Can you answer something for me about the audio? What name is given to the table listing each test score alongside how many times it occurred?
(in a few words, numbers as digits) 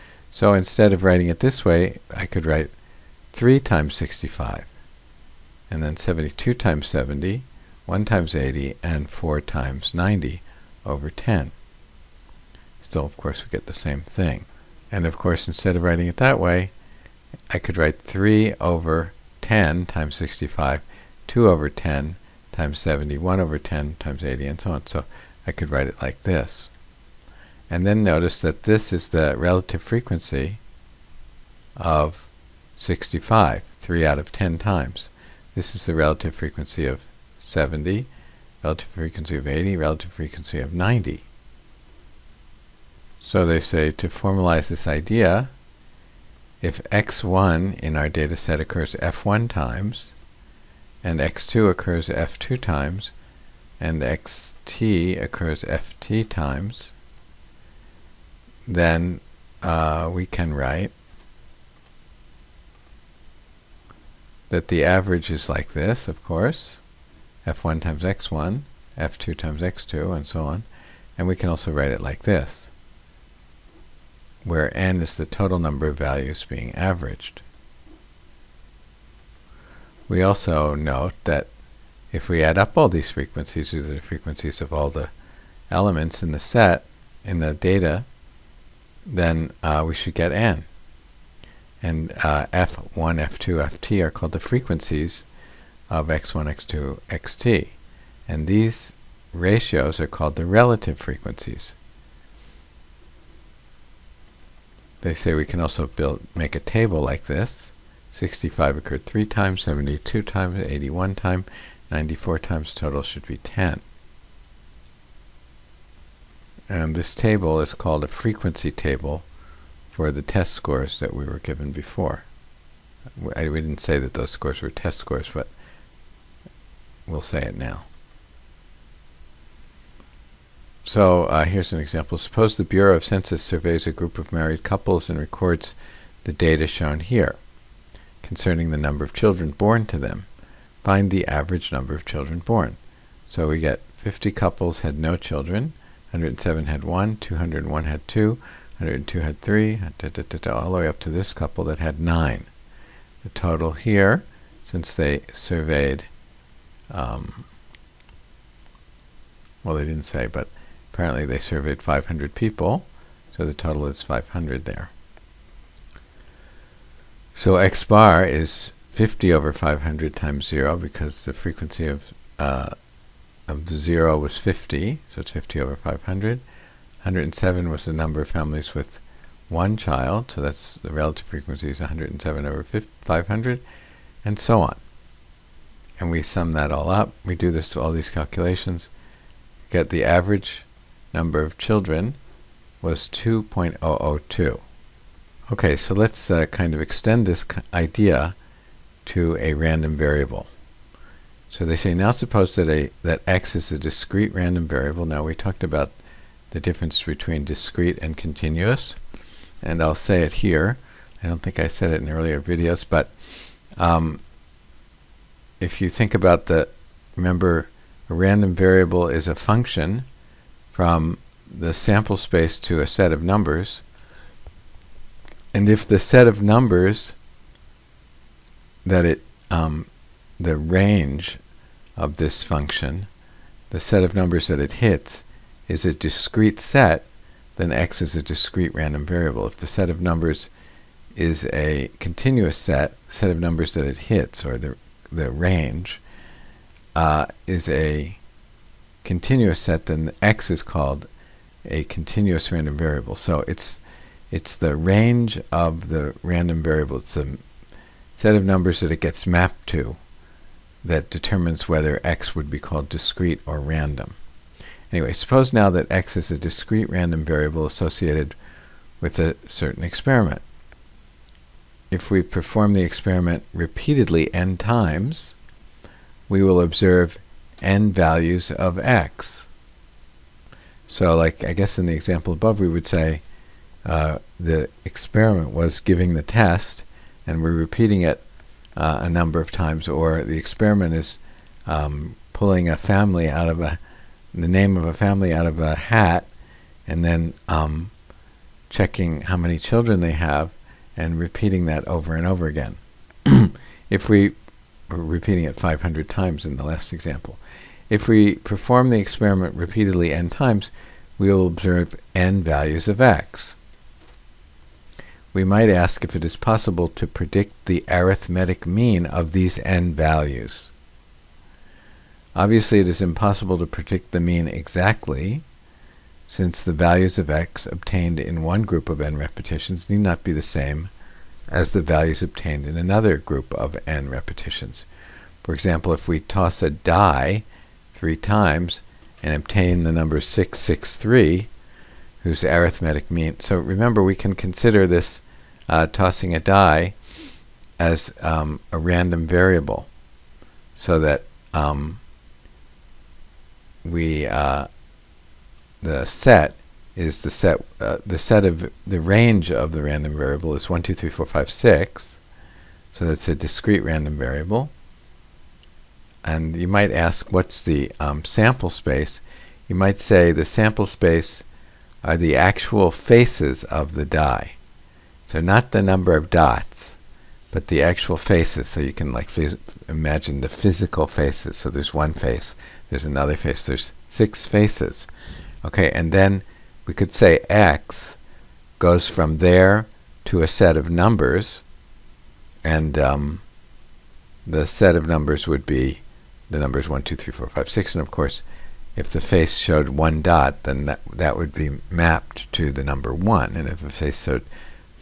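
frequency table.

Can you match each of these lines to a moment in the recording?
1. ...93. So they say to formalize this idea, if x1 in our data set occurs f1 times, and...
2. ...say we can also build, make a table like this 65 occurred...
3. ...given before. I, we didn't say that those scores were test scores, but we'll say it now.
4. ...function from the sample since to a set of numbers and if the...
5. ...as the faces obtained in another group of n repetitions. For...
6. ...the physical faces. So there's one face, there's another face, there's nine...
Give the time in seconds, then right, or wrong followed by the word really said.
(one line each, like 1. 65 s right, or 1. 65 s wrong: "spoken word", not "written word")
1. 40 s wrong: "90", not "93"
2. 105 s right
3. 121 s right
4. 219 s wrong: "space", not "since"
5. 331 s wrong: "values", not "faces"
6. 380 s wrong: "six", not "nine".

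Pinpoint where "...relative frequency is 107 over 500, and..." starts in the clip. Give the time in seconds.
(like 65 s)
180 s.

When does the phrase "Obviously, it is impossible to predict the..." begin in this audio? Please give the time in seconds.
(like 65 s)
322 s.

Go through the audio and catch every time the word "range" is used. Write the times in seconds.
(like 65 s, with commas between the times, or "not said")
230 s, 245 s, 254 s, 359 s.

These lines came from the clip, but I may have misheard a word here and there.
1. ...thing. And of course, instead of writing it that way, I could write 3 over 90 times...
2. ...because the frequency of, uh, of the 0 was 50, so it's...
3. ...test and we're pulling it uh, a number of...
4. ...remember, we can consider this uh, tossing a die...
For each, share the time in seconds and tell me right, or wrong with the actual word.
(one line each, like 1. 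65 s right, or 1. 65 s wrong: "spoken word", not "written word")
1. 14 s wrong: "10", not "90"
2. 170 s right
3. 286 s wrong: "repeating", not "pulling"
4. 343 s right.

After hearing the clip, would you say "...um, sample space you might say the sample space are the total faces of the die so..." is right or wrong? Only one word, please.
wrong.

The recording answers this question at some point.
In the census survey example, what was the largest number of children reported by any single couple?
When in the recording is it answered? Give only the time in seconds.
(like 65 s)
152 s.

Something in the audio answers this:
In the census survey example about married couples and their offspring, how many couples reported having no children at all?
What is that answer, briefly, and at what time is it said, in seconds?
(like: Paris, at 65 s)
50, at 143 s.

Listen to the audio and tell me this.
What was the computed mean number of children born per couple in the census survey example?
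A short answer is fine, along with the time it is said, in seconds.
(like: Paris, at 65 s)
2.002, at 193 s.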